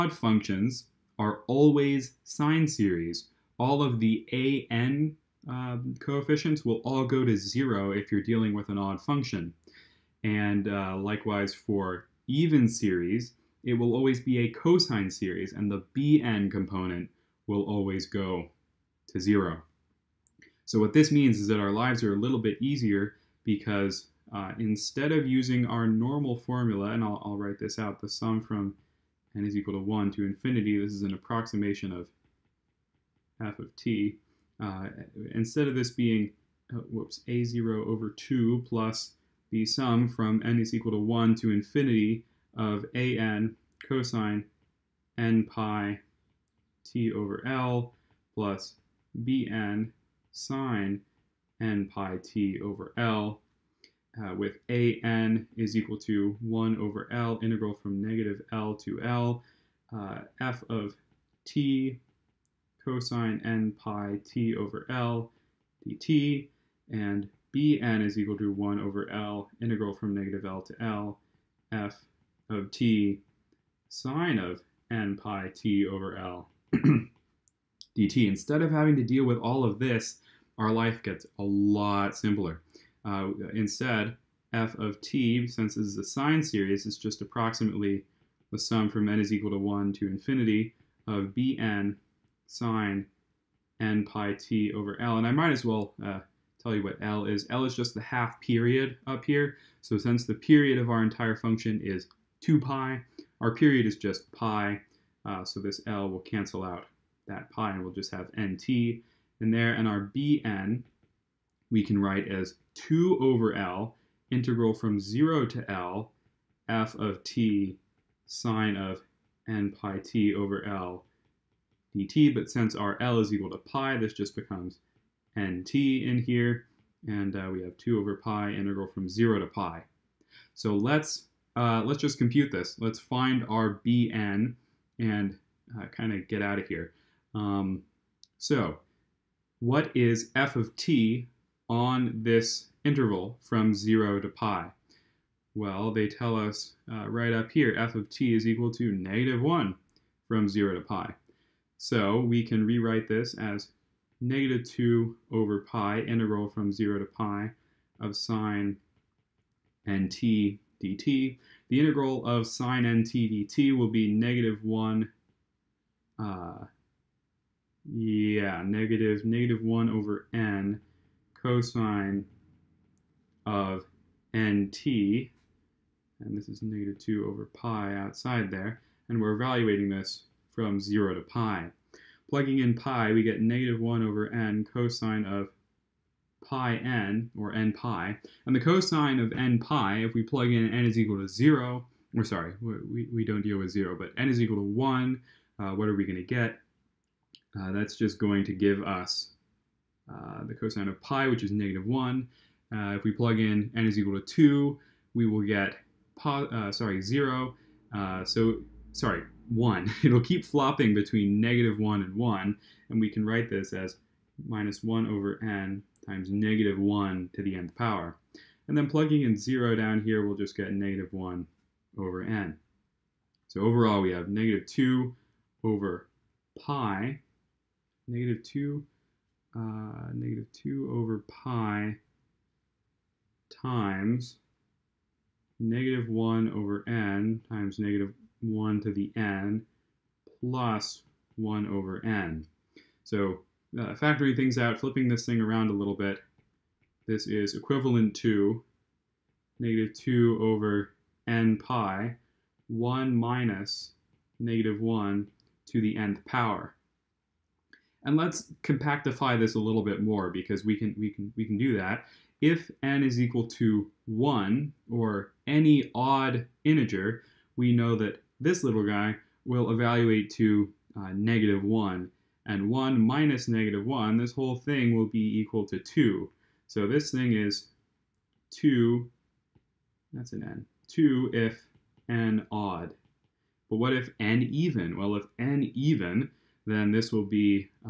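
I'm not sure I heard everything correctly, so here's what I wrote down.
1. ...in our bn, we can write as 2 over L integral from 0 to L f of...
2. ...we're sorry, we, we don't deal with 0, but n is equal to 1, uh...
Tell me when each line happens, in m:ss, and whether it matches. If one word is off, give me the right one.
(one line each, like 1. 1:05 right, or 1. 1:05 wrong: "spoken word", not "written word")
1. 1:49 right
2. 3:12 right.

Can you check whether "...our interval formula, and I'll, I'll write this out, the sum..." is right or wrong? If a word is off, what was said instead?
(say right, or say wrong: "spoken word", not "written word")
wrong: "normal", not "interval".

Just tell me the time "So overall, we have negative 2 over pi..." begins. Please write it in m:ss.
3:43.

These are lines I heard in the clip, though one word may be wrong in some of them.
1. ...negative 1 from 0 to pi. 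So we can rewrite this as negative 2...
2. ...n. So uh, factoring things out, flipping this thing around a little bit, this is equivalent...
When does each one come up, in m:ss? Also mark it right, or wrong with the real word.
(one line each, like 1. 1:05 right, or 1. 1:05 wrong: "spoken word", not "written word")
1. 2:28 right
2. 4:02 right.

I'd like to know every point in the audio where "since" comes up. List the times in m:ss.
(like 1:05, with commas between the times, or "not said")
1:25, 1:39, 2:02.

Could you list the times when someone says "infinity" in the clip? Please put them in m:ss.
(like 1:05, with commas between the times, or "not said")
0:30, 0:41, 1:30.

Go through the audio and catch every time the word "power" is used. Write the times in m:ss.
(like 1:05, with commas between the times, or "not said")
3:37, 4:16.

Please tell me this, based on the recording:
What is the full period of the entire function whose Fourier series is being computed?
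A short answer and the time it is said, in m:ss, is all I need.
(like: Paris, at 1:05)
2 pi, at 1:42.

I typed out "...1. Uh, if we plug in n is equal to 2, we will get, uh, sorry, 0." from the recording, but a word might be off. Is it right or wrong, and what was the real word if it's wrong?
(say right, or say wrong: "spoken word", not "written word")
right.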